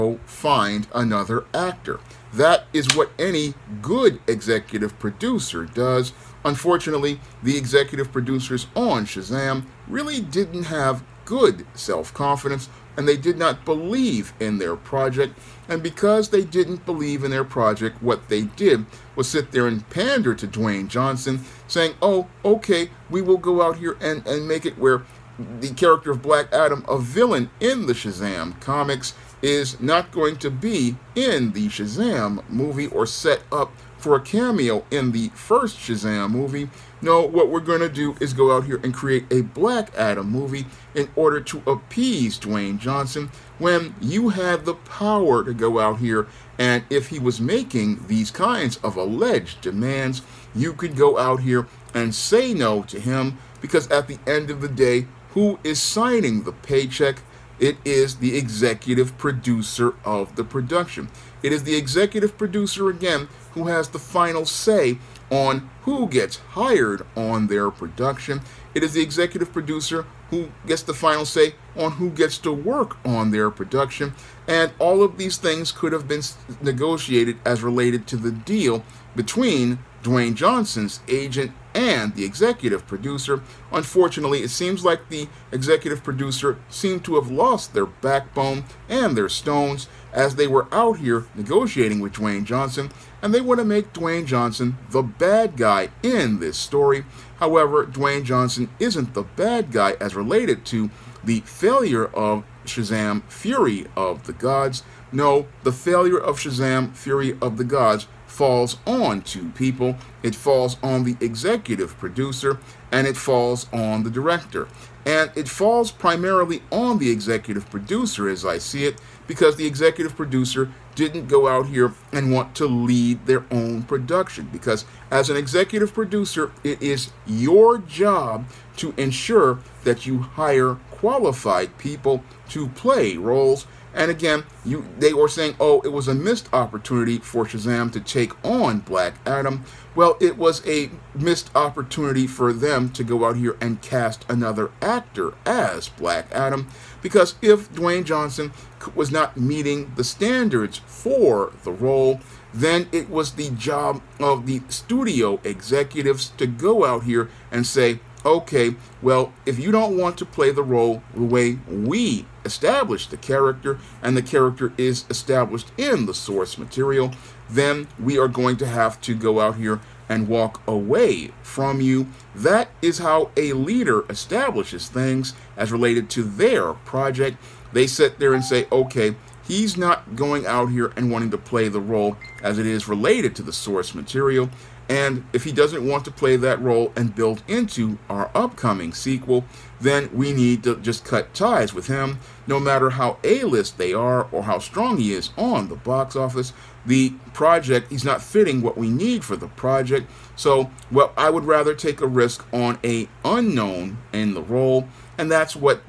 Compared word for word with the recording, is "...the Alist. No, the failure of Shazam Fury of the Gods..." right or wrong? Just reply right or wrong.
wrong.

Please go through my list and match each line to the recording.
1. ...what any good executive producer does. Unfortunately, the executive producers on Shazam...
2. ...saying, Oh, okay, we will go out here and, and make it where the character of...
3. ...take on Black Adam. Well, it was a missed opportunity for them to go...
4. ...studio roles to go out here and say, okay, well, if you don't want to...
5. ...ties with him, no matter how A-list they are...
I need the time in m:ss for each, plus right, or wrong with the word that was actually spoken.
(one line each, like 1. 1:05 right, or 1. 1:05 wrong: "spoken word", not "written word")
1. 0:02 right
2. 0:21 right
3. 2:18 right
4. 2:34 wrong: "executives", not "roles"
5. 3:11 right.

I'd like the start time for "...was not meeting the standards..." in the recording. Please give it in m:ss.
2:28.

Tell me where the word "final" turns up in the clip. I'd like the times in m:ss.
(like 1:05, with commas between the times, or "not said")
1:03, 1:10.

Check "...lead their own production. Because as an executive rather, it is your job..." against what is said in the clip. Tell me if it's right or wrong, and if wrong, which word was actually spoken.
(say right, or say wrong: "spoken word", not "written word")
wrong: "producer", not "rather".